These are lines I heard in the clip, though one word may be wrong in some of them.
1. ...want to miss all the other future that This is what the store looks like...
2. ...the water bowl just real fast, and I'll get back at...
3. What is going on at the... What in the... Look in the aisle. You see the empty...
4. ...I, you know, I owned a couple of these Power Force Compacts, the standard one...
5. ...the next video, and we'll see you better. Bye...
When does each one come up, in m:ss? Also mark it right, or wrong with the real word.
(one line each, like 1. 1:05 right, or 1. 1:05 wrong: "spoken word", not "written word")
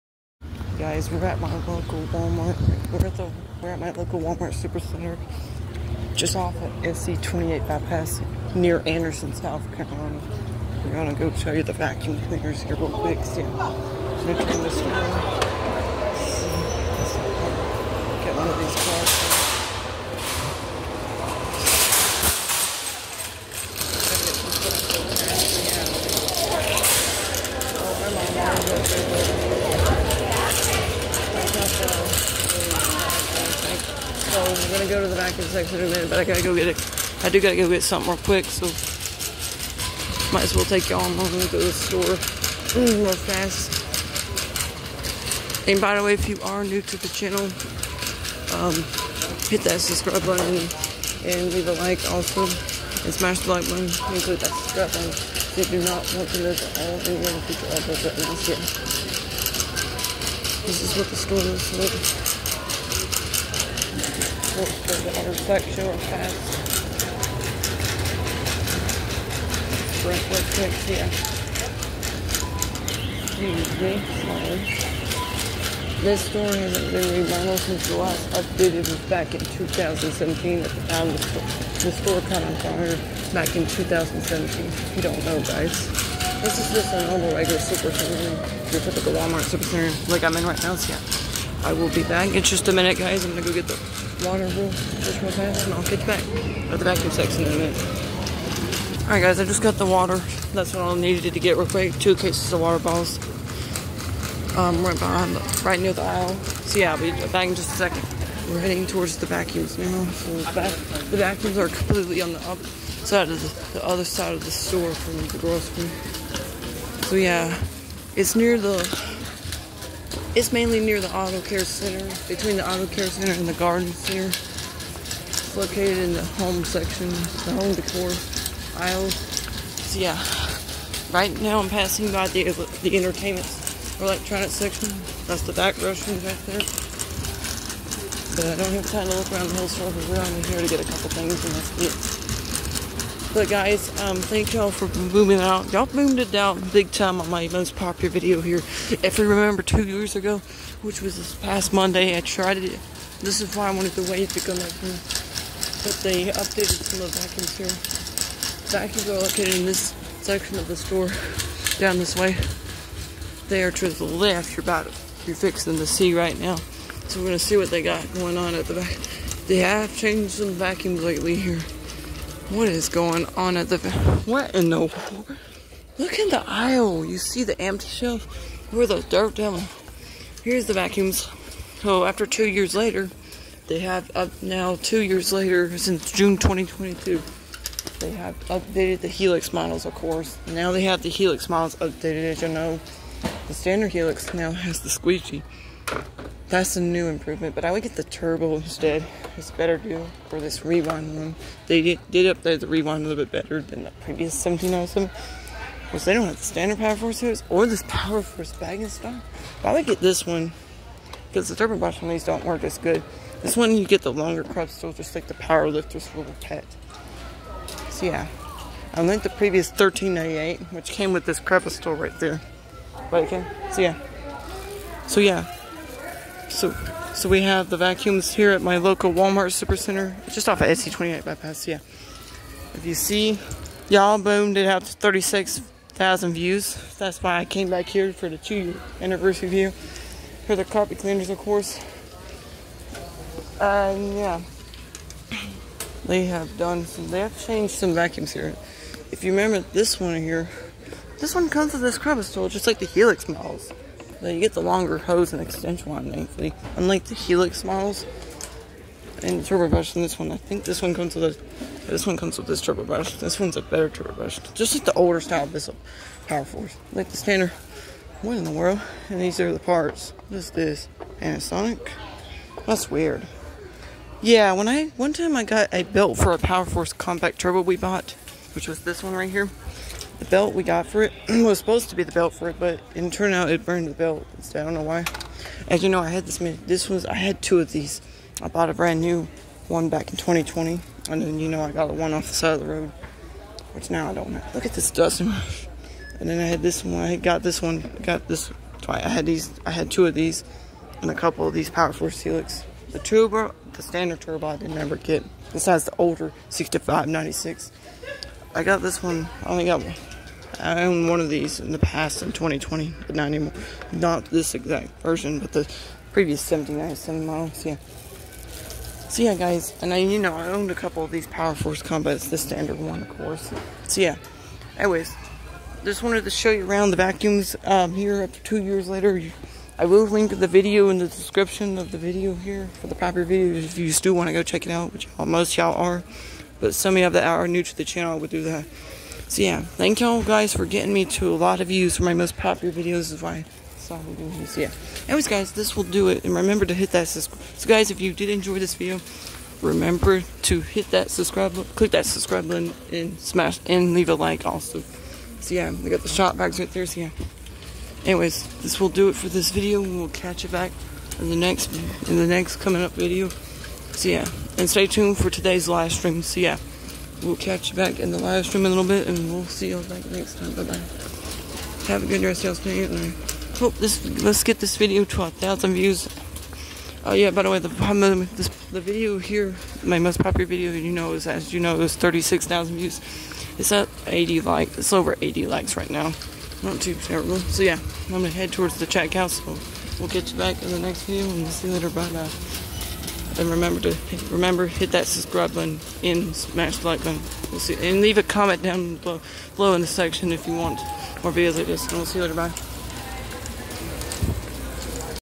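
1. 0:56 right
2. 1:33 right
3. 2:52 right
4. 5:19 right
5. 6:30 wrong: "later", not "better".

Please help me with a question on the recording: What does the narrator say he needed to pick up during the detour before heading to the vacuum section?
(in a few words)
Two cases of water bottles.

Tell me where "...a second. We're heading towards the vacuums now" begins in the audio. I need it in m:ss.
1:47.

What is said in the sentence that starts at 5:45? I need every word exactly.
Anyways guys, this will do it.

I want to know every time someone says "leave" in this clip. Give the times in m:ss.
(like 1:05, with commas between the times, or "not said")
0:51, 5:53, 6:38.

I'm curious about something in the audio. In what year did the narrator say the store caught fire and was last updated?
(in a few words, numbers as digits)
2017.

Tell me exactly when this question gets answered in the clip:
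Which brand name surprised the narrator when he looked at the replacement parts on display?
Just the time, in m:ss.
4:31.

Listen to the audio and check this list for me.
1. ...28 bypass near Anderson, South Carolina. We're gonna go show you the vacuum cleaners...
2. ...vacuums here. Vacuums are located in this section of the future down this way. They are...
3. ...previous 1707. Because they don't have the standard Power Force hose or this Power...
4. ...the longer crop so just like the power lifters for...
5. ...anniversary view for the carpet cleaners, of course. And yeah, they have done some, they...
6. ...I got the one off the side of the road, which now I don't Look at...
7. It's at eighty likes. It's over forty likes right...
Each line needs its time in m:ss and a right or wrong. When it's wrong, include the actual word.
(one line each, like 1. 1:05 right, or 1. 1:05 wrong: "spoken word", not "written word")
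1. 0:07 right
2. 2:37 wrong: "store", not "future"
3. 3:24 right
4. 3:34 right
5. 3:59 right
6. 4:51 right
7. 6:23 wrong: "eighty", not "forty".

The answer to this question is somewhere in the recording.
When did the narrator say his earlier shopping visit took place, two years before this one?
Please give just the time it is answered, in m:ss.
3:06.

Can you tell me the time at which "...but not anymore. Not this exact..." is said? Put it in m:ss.
5:13.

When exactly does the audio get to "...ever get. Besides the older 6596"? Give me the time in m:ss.
5:04.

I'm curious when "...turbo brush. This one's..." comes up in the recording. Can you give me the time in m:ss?
4:22.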